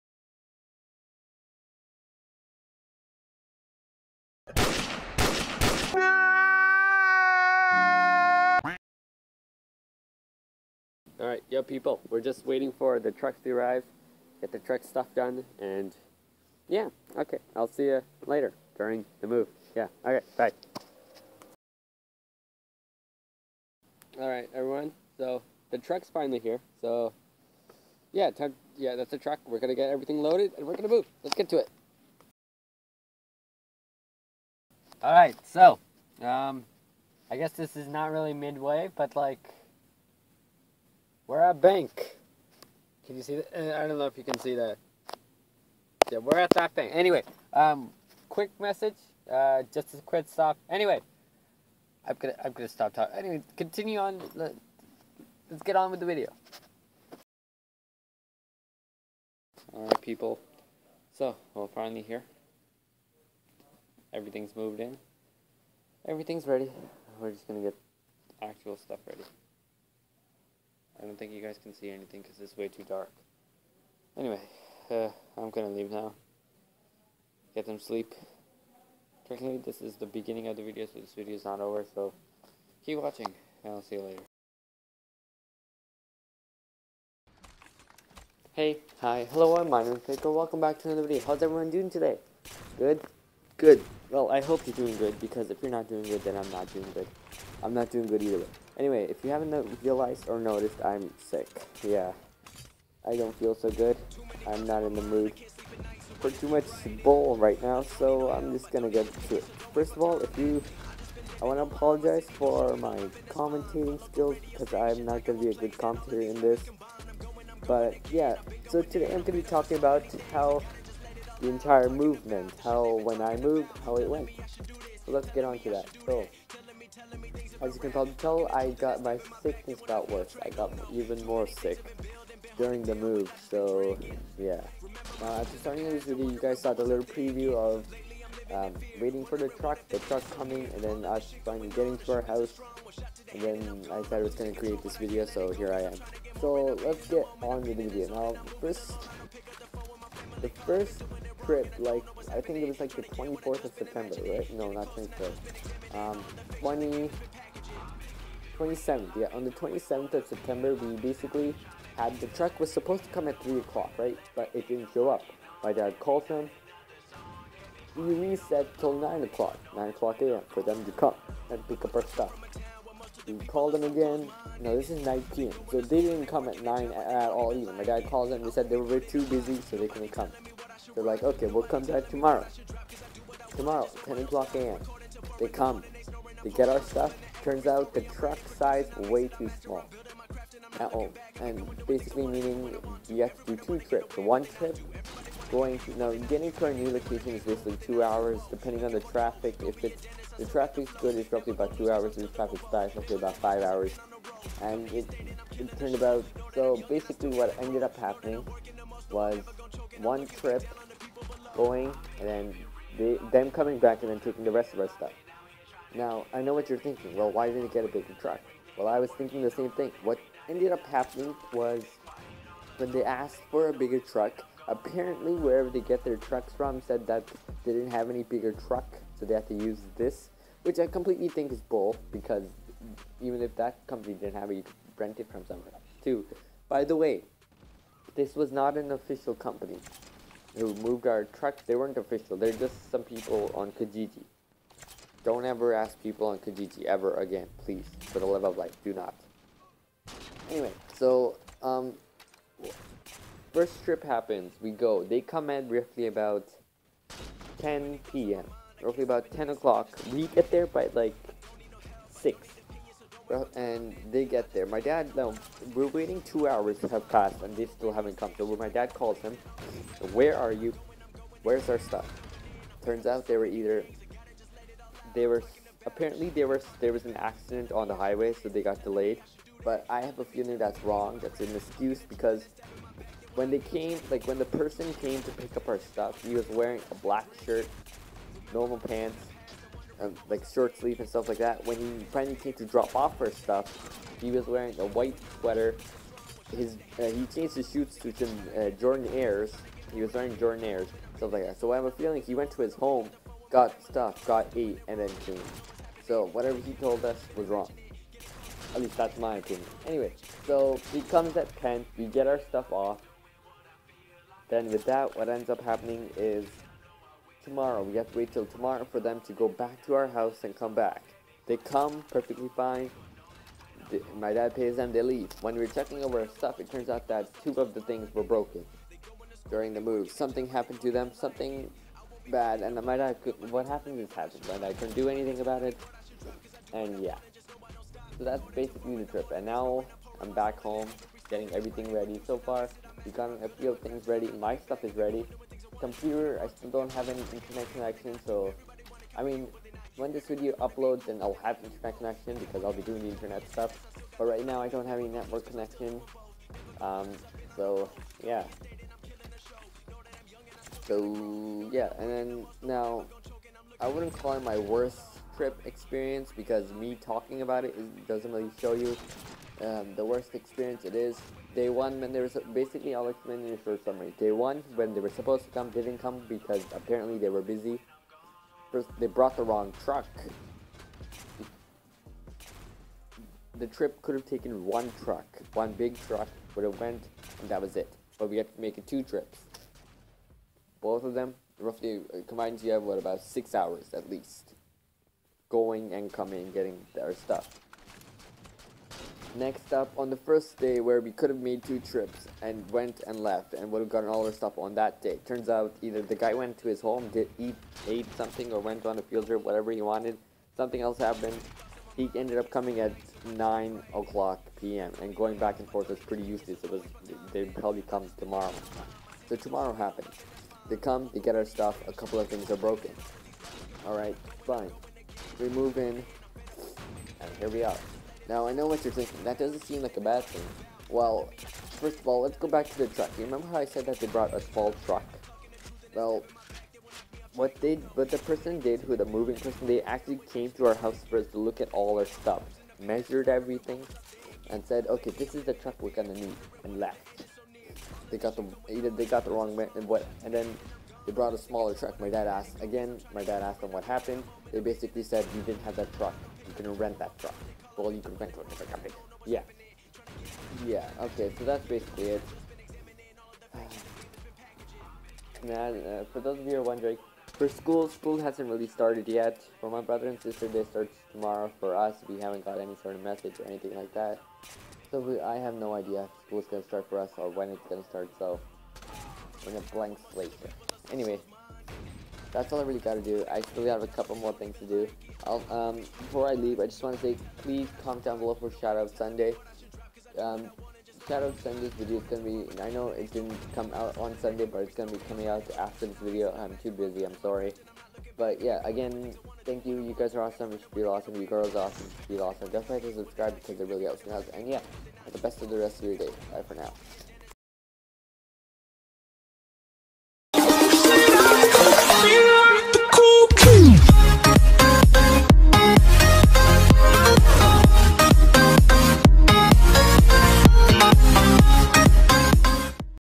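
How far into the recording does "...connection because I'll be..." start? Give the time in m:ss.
5:51.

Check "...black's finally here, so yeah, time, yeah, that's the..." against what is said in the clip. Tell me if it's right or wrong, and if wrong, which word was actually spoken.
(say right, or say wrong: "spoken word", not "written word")
wrong: "truck", not "black".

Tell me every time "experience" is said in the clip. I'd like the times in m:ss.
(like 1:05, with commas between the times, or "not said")
6:05, 6:10.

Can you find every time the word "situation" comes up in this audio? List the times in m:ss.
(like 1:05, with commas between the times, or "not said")
not said.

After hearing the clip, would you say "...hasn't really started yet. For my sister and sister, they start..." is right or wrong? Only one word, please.
wrong.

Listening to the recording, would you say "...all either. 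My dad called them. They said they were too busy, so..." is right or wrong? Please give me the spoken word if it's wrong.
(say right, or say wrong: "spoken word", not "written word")
right.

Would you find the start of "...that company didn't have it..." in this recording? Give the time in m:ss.
3:53.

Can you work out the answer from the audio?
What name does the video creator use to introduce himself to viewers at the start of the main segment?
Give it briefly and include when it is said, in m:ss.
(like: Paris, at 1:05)
Minor Pickle, at 1:29.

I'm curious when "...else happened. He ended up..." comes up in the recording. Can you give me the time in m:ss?
6:50.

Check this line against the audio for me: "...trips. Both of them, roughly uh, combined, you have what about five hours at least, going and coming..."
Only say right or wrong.
wrong.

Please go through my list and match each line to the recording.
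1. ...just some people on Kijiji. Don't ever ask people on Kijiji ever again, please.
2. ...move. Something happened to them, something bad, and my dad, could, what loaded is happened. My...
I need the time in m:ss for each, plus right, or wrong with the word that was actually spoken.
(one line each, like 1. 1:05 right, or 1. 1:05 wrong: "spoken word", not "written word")
1. 4:02 right
2. 5:29 wrong: "happened", not "loaded".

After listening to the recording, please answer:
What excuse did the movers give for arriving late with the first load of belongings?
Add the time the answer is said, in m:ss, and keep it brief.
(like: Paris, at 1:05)
accident on the highway, at 4:37.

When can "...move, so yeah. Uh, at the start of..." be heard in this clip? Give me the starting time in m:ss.
2:12.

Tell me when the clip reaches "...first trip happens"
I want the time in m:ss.
4:13.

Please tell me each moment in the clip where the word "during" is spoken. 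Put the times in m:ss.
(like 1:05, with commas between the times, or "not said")
0:18, 2:12, 5:29.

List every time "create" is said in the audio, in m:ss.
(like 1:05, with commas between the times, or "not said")
2:24.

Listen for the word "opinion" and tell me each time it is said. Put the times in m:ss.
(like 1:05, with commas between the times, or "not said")
5:09.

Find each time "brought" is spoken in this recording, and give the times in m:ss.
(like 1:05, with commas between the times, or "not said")
6:19, 7:14, 7:31.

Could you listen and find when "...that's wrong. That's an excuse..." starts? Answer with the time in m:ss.
4:40.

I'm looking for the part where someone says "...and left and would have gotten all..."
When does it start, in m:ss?
6:43.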